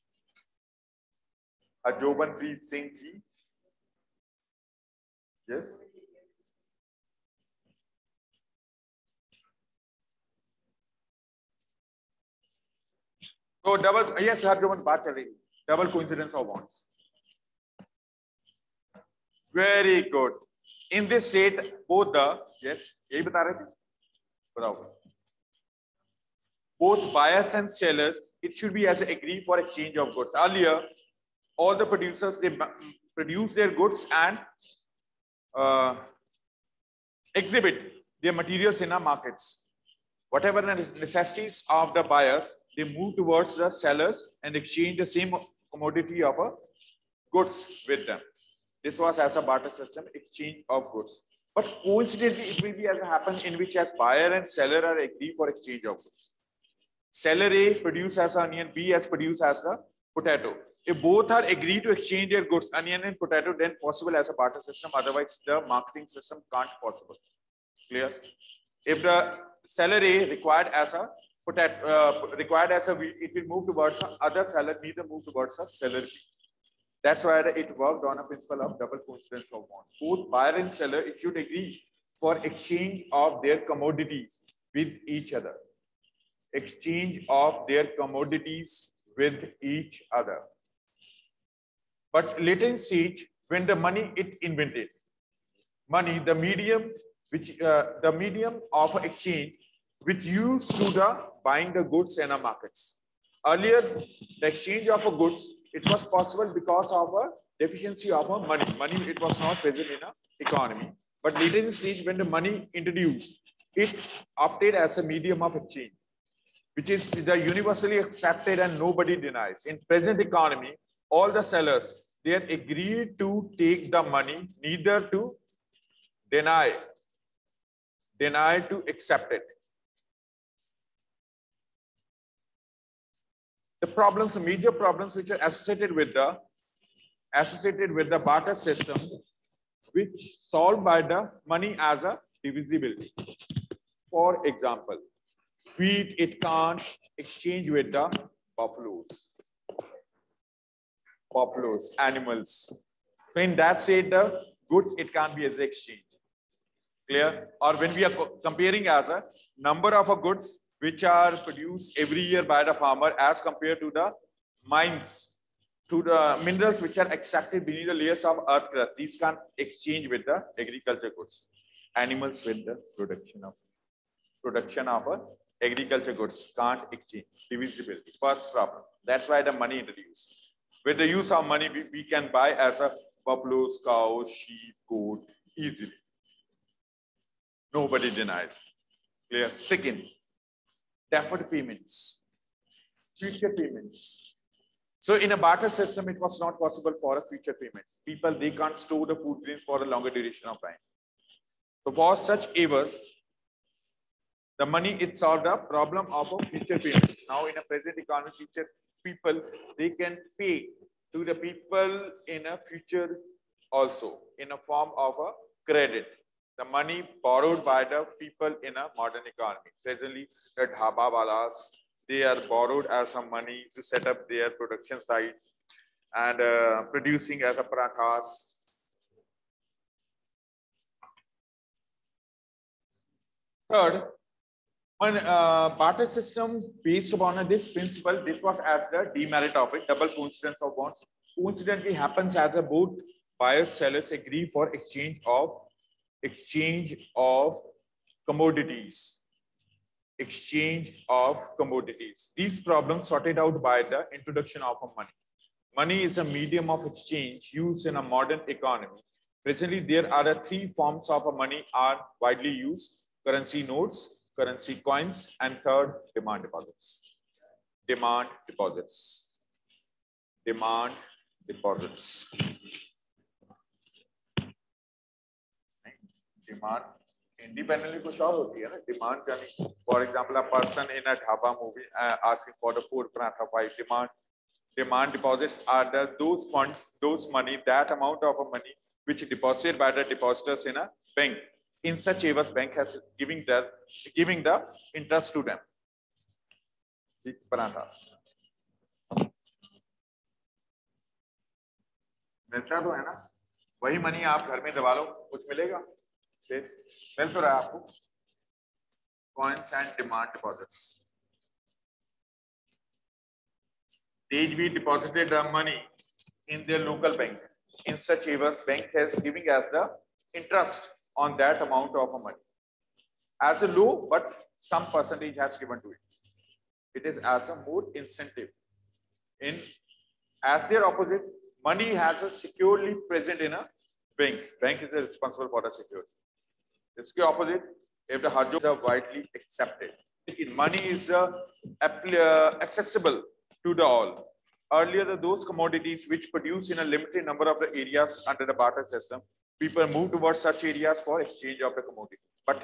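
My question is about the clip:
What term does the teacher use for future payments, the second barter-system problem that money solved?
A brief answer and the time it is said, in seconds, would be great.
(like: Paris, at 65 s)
Deferred payments, at 191 s.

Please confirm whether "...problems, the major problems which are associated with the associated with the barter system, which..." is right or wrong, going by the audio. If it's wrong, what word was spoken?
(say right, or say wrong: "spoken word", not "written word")
right.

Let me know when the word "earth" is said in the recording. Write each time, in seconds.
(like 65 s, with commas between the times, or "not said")
168 s.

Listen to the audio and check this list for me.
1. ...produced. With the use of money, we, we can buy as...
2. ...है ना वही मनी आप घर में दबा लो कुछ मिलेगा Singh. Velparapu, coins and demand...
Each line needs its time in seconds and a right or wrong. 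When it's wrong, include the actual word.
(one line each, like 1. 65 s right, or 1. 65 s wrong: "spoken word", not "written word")
1. 179 s wrong: "introduced", not "produced"
2. 302 s wrong: "Okay", not "Singh".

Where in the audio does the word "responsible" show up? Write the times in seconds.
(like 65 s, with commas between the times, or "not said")
334 s.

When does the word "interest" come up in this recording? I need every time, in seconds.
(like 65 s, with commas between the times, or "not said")
320 s.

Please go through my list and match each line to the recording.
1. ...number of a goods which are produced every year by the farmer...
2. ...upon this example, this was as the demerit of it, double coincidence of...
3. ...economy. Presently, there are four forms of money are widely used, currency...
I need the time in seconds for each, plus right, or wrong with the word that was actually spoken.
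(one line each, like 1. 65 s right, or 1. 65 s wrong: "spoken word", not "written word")
1. 159 s right
2. 237 s wrong: "principle", not "example"
3. 258 s wrong: "three", not "four".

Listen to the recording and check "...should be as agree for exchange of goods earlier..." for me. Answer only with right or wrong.
right.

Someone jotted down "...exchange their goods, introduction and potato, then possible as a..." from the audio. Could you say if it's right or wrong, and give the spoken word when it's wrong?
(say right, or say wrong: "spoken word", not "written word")
wrong: "onion", not "introduction".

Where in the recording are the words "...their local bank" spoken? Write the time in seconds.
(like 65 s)
316 s.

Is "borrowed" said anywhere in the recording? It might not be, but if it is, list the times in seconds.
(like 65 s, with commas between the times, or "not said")
217 s, 222 s.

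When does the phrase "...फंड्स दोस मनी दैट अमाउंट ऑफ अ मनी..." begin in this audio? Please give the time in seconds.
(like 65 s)
286 s.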